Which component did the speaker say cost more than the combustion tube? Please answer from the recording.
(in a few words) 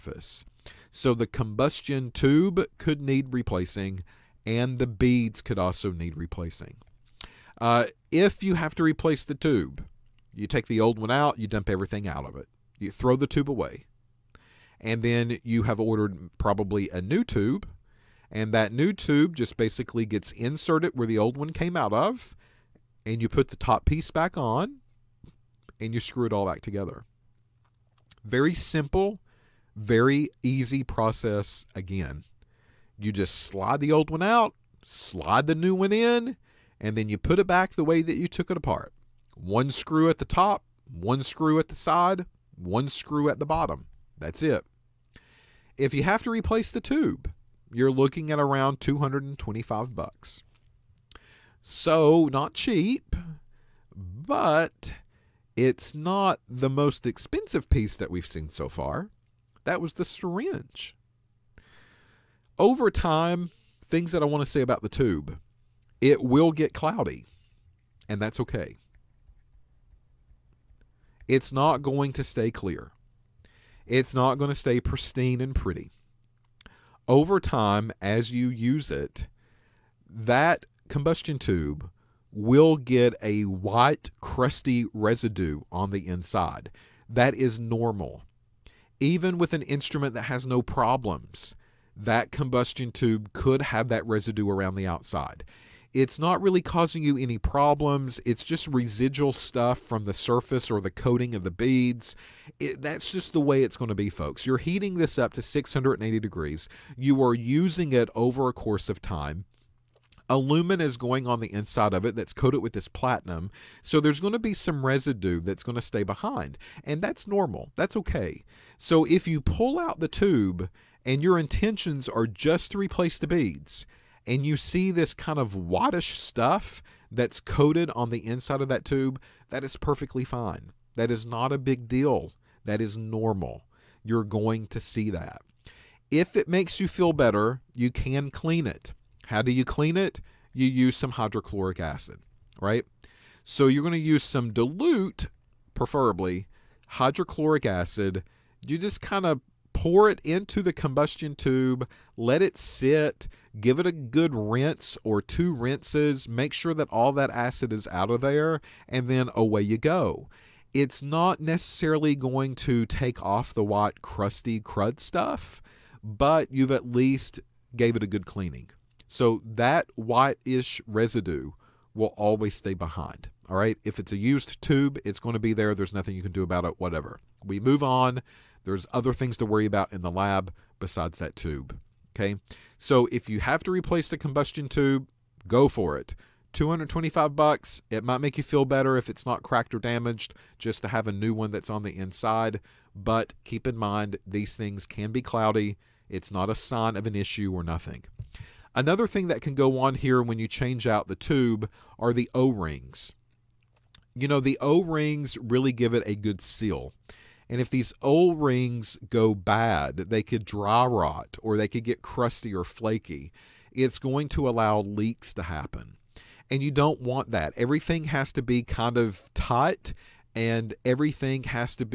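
The syringe.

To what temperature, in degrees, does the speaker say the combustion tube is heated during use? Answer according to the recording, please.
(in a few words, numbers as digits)
680 degrees.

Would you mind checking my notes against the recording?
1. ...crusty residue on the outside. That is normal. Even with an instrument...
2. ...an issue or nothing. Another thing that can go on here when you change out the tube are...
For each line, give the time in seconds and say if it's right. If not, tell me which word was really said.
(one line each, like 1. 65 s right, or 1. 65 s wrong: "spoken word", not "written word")
1. 84 s wrong: "inside", not "outside"
2. 197 s right.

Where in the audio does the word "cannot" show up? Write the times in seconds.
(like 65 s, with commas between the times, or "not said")
not said.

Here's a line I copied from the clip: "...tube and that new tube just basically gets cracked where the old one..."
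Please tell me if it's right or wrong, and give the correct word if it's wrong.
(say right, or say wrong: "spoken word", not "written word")
wrong: "inserted", not "cracked".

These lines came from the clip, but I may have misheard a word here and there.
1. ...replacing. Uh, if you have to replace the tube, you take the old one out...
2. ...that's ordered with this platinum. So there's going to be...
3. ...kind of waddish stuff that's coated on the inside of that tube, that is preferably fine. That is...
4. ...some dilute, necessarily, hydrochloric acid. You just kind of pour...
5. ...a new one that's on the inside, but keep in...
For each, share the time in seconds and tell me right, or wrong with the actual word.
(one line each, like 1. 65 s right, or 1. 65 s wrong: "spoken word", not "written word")
1. 6 s right
2. 112 s wrong: "coated", not "ordered"
3. 125 s wrong: "perfectly", not "preferably"
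4. 144 s wrong: "preferably", not "necessarily"
5. 191 s right.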